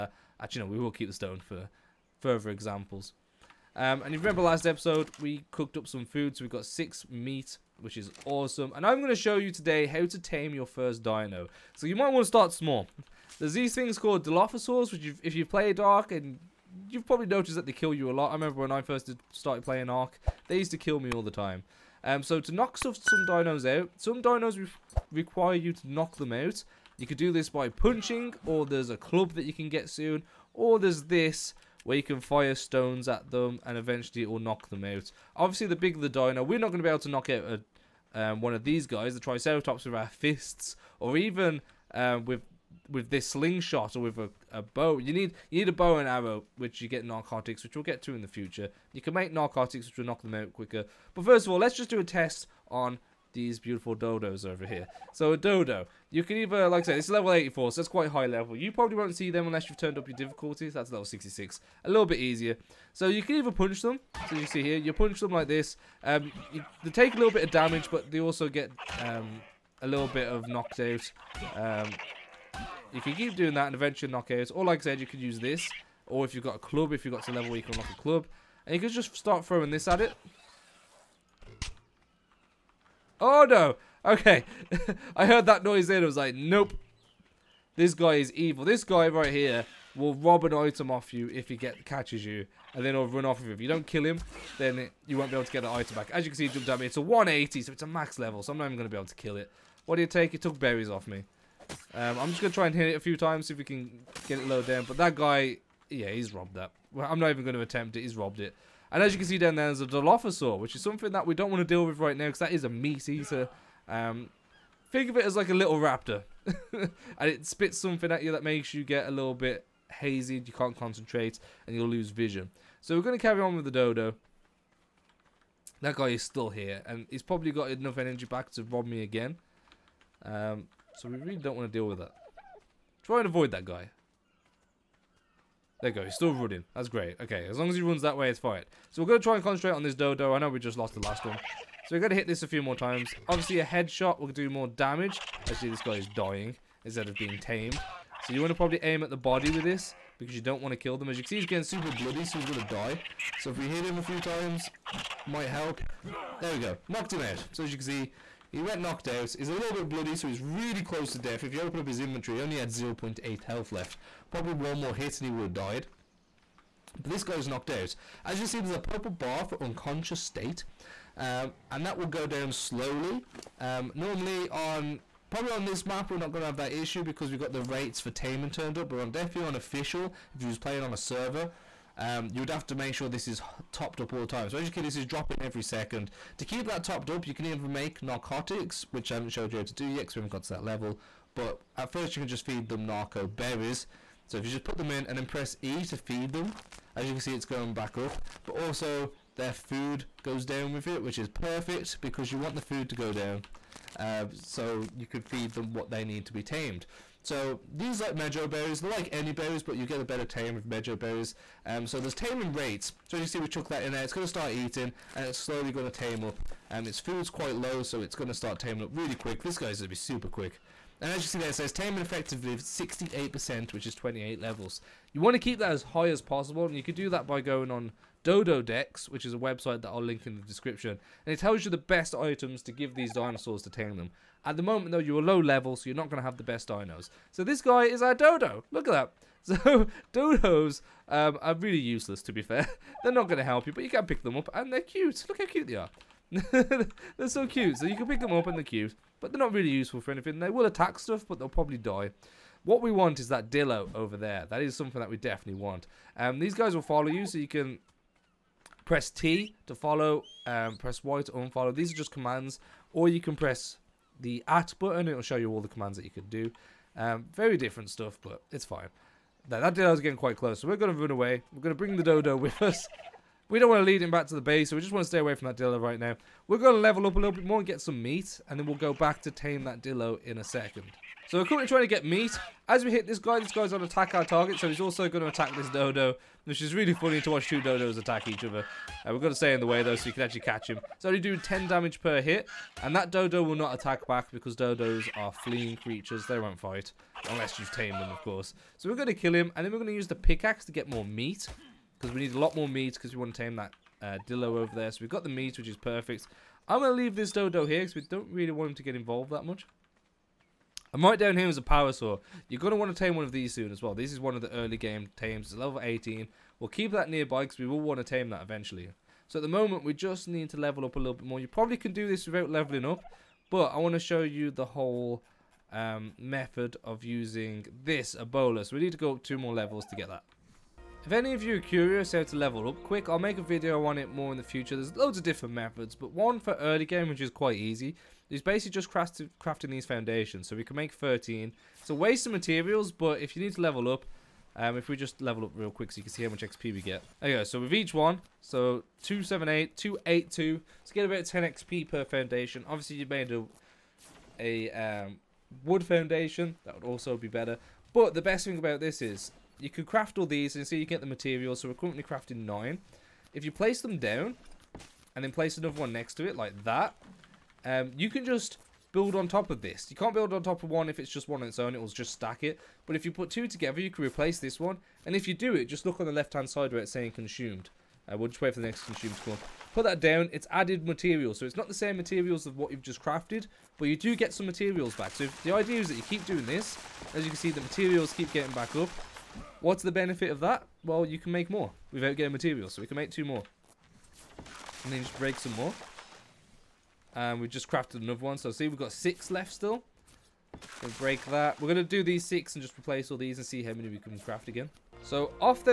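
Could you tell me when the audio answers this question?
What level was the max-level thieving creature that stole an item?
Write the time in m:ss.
1:37.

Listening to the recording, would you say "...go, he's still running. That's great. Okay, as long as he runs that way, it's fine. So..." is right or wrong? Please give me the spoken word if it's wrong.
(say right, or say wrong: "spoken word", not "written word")
right.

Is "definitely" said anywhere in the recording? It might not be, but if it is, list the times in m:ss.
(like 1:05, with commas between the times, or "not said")
2:59, 4:15.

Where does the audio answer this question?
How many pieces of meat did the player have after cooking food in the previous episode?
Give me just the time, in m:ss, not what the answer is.
0:06.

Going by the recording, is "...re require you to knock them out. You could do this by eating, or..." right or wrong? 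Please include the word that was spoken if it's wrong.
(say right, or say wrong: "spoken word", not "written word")
wrong: "punching", not "eating".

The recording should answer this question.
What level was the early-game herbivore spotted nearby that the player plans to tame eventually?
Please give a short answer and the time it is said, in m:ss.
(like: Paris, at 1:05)
18, at 5:15.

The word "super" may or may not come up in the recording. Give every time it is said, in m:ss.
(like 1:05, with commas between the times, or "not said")
2:31, 3:39.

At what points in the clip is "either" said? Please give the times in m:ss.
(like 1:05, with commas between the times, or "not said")
0:56, 1:03.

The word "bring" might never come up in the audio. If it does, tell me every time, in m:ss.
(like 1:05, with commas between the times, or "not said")
4:31.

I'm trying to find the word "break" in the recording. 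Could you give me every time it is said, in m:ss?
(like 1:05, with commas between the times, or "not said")
6:35, 6:40.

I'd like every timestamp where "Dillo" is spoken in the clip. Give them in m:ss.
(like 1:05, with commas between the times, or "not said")
4:13, 4:35, 4:39, 5:04.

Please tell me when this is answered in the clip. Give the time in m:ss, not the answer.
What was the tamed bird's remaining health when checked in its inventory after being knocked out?
2:42.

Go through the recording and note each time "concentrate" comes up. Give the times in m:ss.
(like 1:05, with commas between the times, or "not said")
2:00, 2:19.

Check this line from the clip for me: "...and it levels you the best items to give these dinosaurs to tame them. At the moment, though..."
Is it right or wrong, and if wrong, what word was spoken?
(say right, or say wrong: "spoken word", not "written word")
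wrong: "tells", not "levels".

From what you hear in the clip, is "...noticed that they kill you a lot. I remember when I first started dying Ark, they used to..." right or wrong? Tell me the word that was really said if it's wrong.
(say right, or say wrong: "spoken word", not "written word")
wrong: "playing", not "dying".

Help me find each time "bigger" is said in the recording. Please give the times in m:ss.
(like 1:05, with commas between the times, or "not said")
0:35.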